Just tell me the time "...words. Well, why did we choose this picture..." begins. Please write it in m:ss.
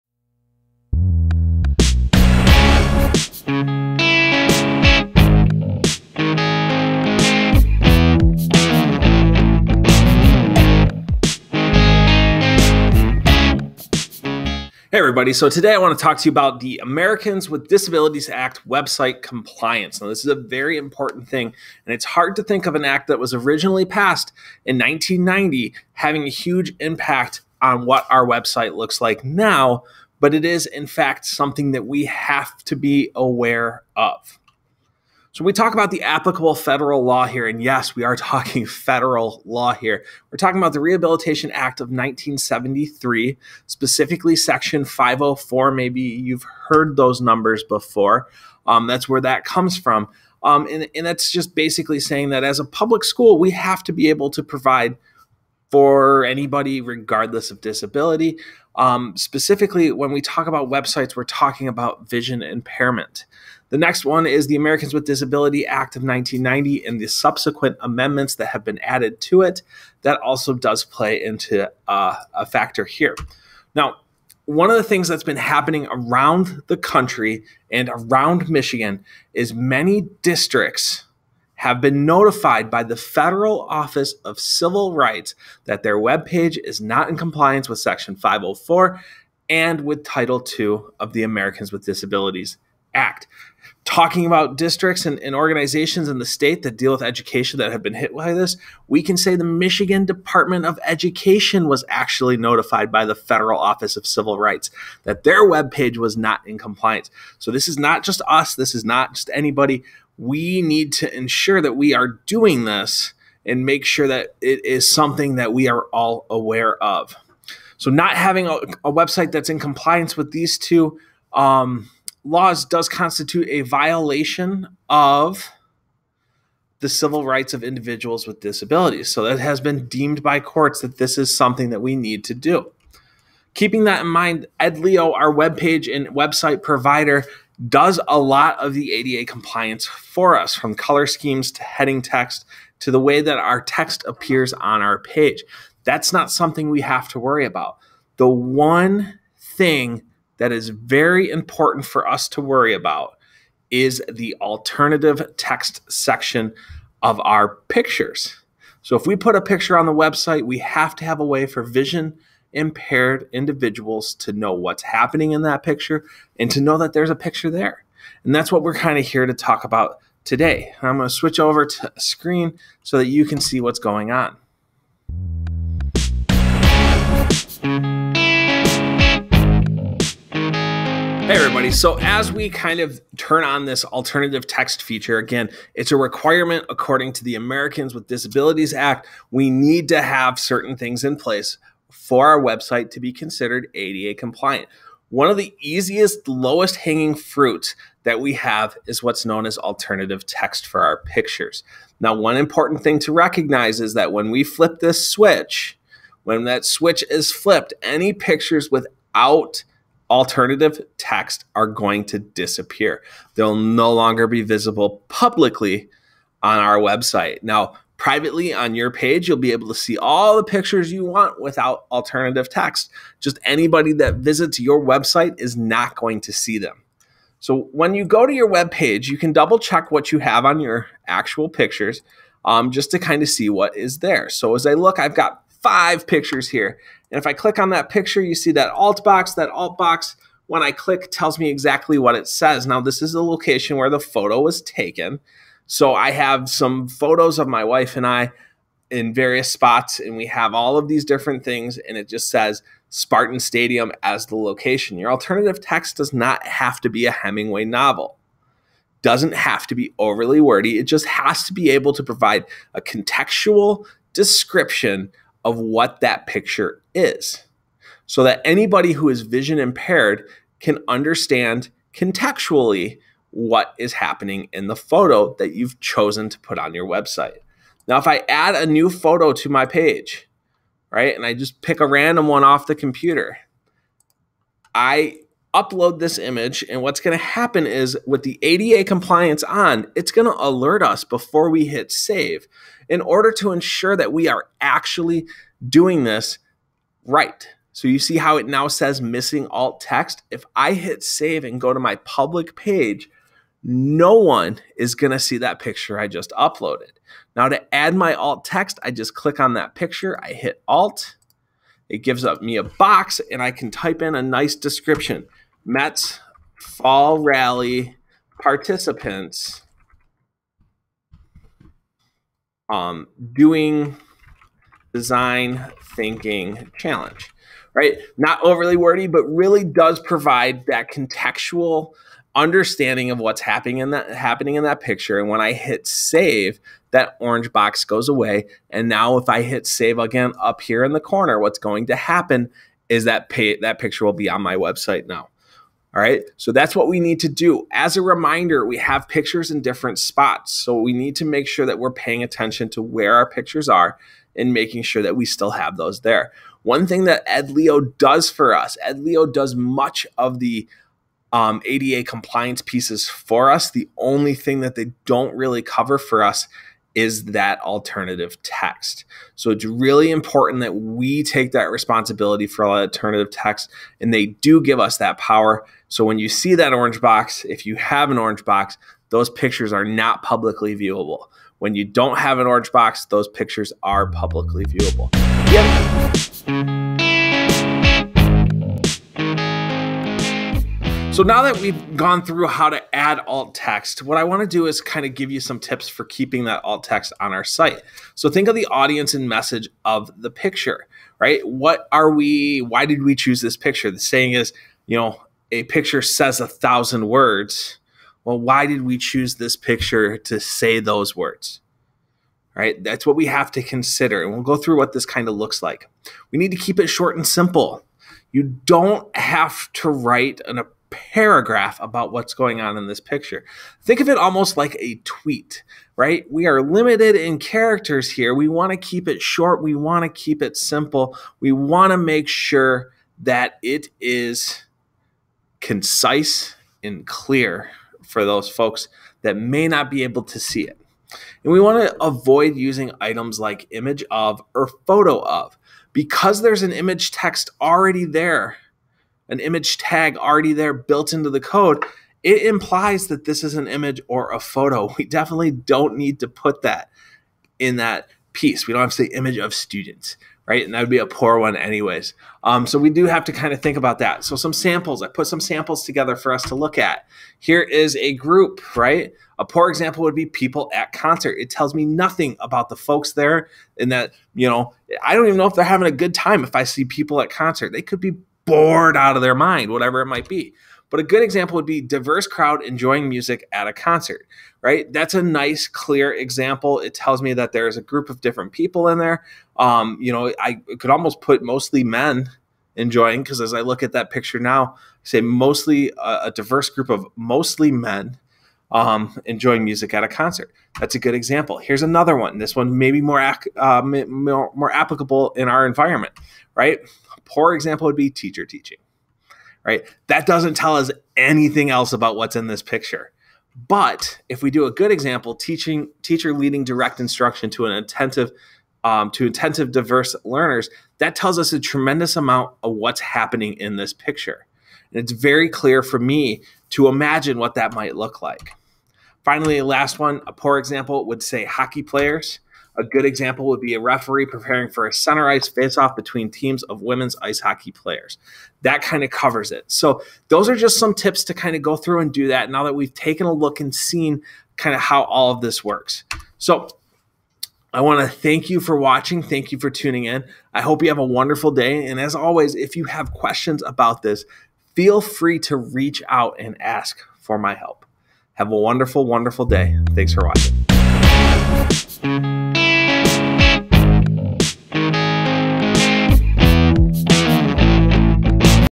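6:47.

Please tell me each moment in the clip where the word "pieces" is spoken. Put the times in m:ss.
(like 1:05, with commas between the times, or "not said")
6:02, 7:38.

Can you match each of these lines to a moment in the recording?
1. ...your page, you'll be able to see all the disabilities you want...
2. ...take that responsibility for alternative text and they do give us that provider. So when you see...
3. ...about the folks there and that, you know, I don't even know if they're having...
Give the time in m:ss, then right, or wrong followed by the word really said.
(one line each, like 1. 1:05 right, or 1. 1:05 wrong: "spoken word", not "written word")
1. 3:38 wrong: "pictures", not "disabilities"
2. 6:11 wrong: "power", not "provider"
3. 7:52 right.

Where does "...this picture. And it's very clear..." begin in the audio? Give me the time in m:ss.
8:43.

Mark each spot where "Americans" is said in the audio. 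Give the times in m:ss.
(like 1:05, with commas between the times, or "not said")
0:16, 1:04, 1:31, 3:07.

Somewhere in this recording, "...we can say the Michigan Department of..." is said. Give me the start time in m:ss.
1:38.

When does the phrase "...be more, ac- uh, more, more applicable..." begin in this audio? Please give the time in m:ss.
8:22.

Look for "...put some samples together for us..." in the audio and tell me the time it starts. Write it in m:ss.
7:45.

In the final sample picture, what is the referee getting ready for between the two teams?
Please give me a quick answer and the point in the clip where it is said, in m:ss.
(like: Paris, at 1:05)
Center ice face-off, at 8:54.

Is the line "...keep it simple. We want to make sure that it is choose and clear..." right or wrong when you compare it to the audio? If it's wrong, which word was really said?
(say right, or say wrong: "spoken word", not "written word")
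wrong: "concise", not "choose".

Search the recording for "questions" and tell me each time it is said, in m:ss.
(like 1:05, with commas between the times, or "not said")
9:13.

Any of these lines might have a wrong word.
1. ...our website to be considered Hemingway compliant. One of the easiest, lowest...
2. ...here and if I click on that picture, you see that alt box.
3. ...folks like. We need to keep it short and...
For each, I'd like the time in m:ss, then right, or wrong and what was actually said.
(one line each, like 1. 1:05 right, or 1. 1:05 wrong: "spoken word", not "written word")
1. 3:12 wrong: "ADA", not "Hemingway"
2. 3:56 right
3. 6:55 wrong: "looks", not "folks".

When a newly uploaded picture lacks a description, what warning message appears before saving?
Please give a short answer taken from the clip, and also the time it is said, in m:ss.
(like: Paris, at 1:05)
Missing alt text, at 4:59.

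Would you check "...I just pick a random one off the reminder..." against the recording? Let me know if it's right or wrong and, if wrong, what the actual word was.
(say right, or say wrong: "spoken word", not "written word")
wrong: "computer", not "reminder".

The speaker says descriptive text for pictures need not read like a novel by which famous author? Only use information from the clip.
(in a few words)
Hemingway.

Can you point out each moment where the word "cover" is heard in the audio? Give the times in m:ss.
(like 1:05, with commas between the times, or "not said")
6:05, 8:59.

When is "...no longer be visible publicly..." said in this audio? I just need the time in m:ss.
3:33.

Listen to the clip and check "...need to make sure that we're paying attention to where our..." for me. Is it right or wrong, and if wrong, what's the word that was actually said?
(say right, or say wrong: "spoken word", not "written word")
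right.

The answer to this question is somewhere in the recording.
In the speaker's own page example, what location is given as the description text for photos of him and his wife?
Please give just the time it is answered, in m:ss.
4:12.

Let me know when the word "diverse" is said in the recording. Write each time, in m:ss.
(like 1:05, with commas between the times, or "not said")
8:01, 8:16, 8:39.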